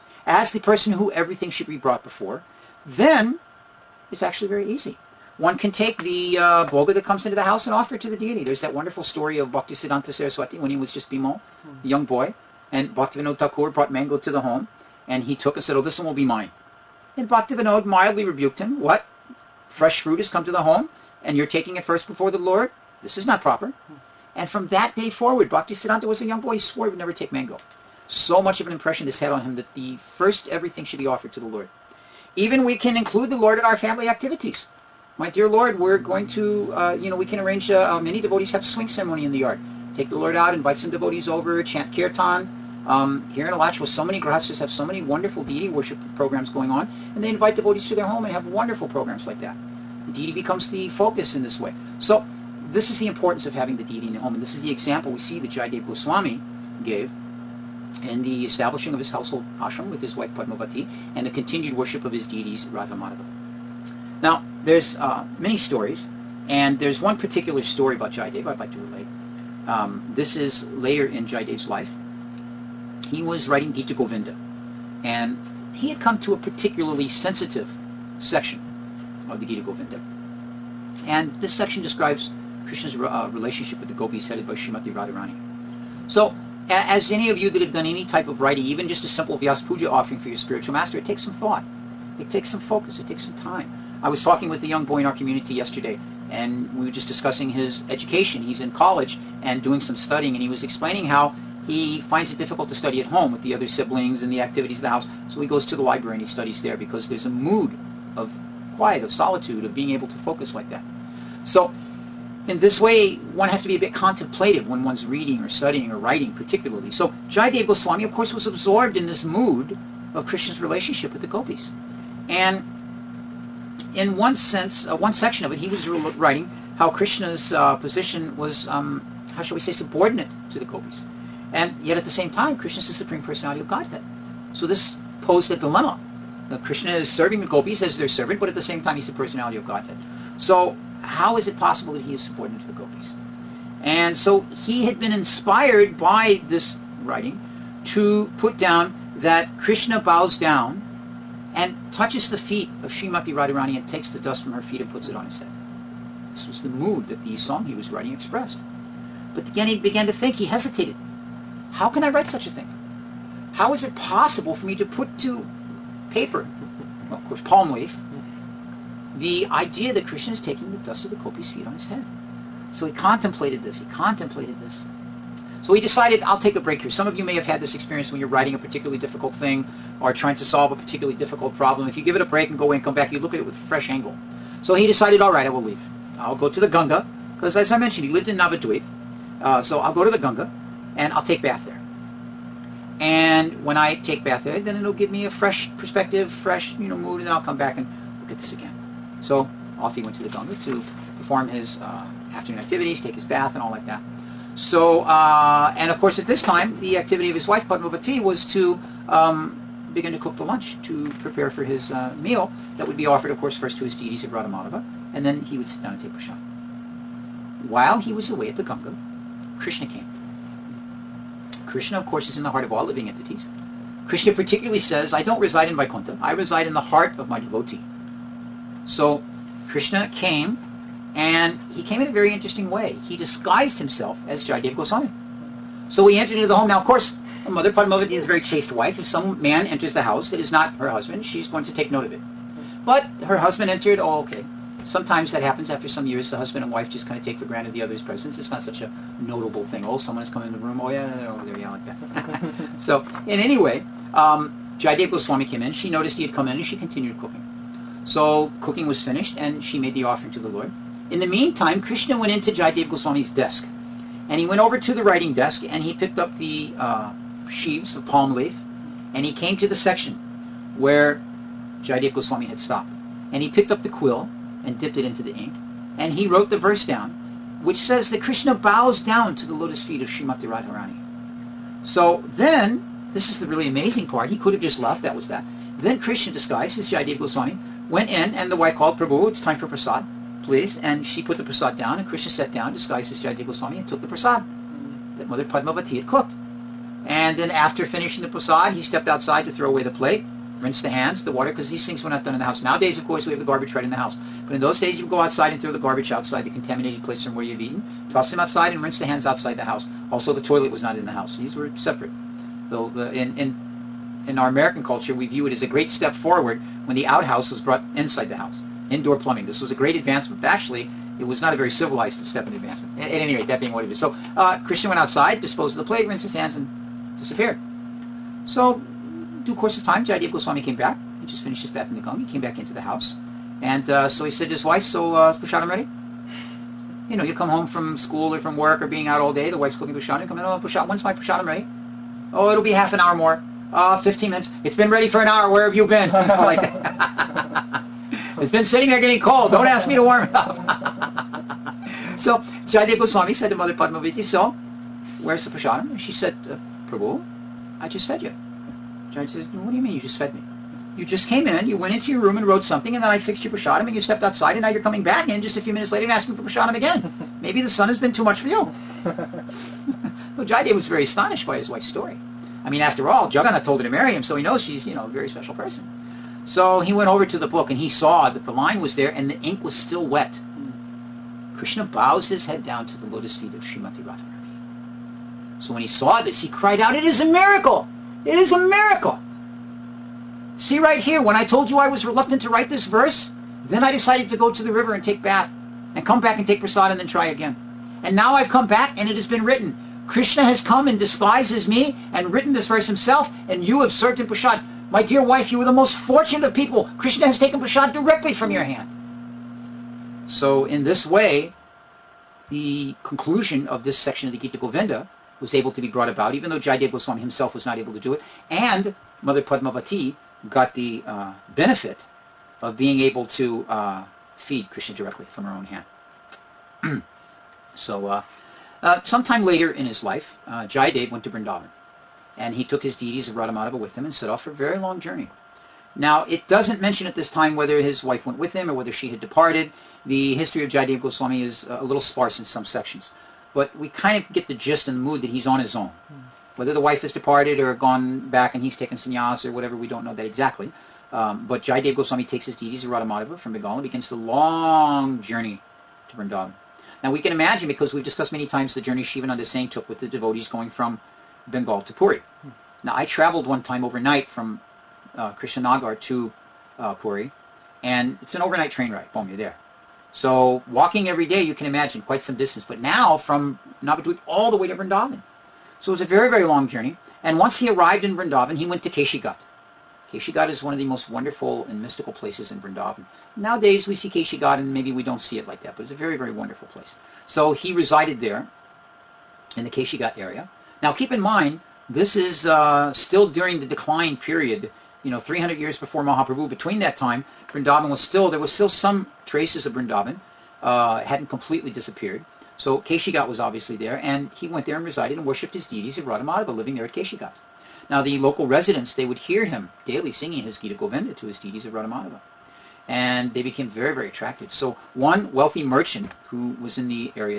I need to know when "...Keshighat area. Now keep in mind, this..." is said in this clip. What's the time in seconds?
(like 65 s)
489 s.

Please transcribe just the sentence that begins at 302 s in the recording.
Nowadays, of course, we have the garbage right in the house.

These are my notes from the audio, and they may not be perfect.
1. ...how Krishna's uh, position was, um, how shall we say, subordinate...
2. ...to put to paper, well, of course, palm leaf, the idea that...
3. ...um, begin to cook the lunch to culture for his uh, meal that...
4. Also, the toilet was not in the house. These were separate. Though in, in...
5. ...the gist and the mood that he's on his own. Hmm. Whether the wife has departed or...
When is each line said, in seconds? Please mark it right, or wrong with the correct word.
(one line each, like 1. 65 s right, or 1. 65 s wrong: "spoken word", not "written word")
1. 126 s right
2. 164 s right
3. 209 s wrong: "prepare", not "culture"
4. 310 s right
5. 444 s right.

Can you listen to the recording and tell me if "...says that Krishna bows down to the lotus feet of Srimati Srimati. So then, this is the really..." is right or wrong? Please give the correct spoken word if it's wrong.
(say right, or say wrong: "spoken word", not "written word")
wrong: "Radharani", not "Srimati".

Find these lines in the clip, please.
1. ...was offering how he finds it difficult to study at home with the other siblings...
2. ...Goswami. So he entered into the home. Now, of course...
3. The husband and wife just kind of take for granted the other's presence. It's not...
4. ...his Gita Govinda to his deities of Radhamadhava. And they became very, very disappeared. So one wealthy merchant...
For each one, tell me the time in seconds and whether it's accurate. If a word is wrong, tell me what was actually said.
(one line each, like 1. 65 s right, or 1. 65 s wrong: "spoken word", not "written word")
1. 100 s wrong: "explaining", not "offering"
2. 234 s right
3. 246 s right
4. 510 s wrong: "attracted", not "disappeared".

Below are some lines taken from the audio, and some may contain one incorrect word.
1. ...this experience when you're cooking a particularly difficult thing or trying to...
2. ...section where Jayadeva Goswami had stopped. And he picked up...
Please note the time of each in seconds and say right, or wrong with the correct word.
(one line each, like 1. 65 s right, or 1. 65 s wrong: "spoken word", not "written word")
1. 177 s wrong: "writing", not "cooking"
2. 269 s right.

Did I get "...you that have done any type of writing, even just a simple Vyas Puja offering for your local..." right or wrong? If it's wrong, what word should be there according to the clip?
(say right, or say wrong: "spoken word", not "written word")
wrong: "spiritual", not "local".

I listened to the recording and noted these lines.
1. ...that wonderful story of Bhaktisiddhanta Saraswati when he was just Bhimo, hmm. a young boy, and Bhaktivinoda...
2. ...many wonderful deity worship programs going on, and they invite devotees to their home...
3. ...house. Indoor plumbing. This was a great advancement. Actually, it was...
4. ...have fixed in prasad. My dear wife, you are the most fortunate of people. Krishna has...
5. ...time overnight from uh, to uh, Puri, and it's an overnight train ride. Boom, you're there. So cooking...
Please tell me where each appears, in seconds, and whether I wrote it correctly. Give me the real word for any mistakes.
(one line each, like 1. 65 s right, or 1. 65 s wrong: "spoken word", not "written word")
1. 8 s right
2. 44 s right
3. 318 s right
4. 403 s wrong: "served", not "fixed"
5. 463 s wrong: "walking", not "cooking".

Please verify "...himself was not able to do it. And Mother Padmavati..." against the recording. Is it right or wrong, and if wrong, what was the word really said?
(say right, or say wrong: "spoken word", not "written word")
right.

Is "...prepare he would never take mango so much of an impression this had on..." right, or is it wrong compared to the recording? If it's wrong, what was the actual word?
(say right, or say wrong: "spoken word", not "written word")
wrong: "swore", not "prepare".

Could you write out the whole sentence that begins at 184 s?
So he decided, all right, I will leave.